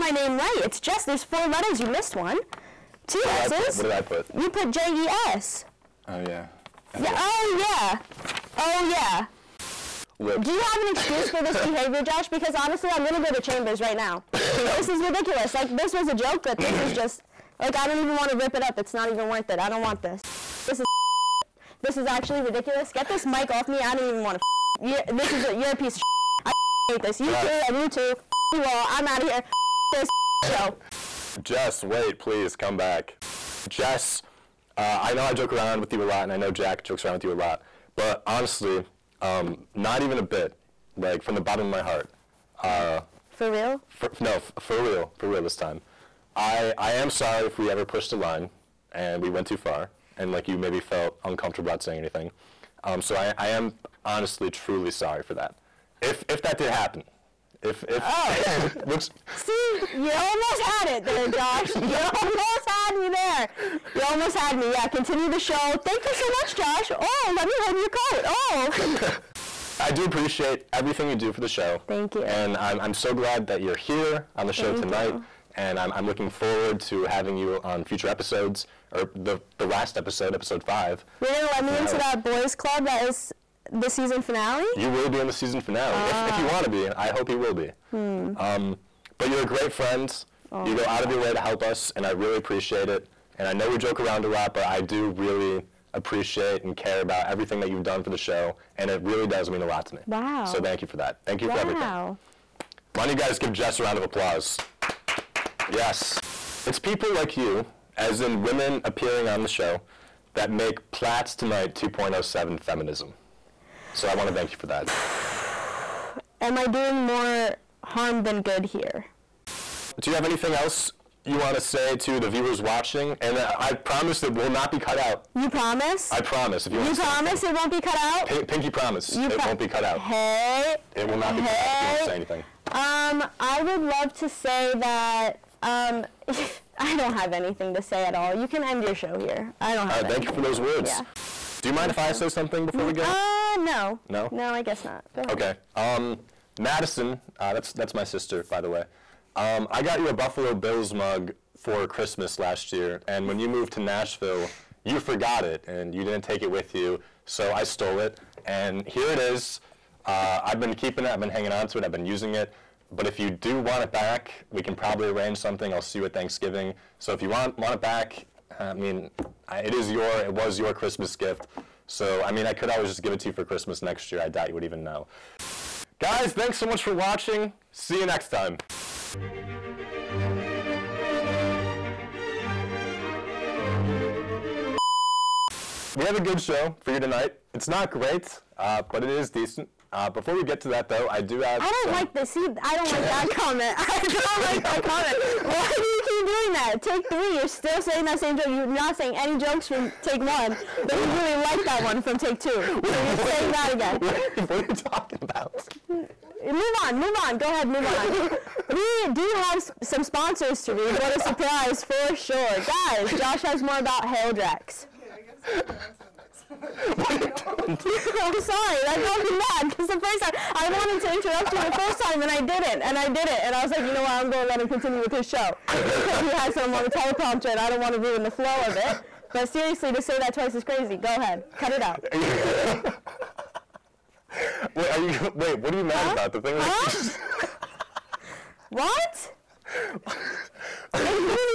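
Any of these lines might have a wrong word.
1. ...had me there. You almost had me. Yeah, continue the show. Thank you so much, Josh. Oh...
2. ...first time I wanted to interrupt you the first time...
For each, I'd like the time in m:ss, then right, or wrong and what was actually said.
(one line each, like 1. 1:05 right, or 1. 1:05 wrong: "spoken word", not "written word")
1. 1:02 right
2. 3:39 right.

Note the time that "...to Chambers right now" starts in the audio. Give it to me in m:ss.
0:13.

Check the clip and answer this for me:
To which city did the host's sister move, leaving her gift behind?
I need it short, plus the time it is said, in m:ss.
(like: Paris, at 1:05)
Nashville, at 2:33.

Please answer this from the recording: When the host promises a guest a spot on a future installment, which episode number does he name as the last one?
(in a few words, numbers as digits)
5.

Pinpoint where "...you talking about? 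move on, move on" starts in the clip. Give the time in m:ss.
3:24.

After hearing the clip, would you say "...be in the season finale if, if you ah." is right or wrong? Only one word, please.
right.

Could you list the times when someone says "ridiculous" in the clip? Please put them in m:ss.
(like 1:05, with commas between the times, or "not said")
0:15, 0:22.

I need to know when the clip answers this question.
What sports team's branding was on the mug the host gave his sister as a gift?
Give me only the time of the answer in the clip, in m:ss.
2:30.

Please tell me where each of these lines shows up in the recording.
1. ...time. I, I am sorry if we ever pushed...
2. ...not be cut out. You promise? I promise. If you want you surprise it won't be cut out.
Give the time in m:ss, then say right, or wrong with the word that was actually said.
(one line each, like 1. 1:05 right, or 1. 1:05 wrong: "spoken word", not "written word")
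1. 0:45 right
2. 2:04 wrong: "promise", not "surprise".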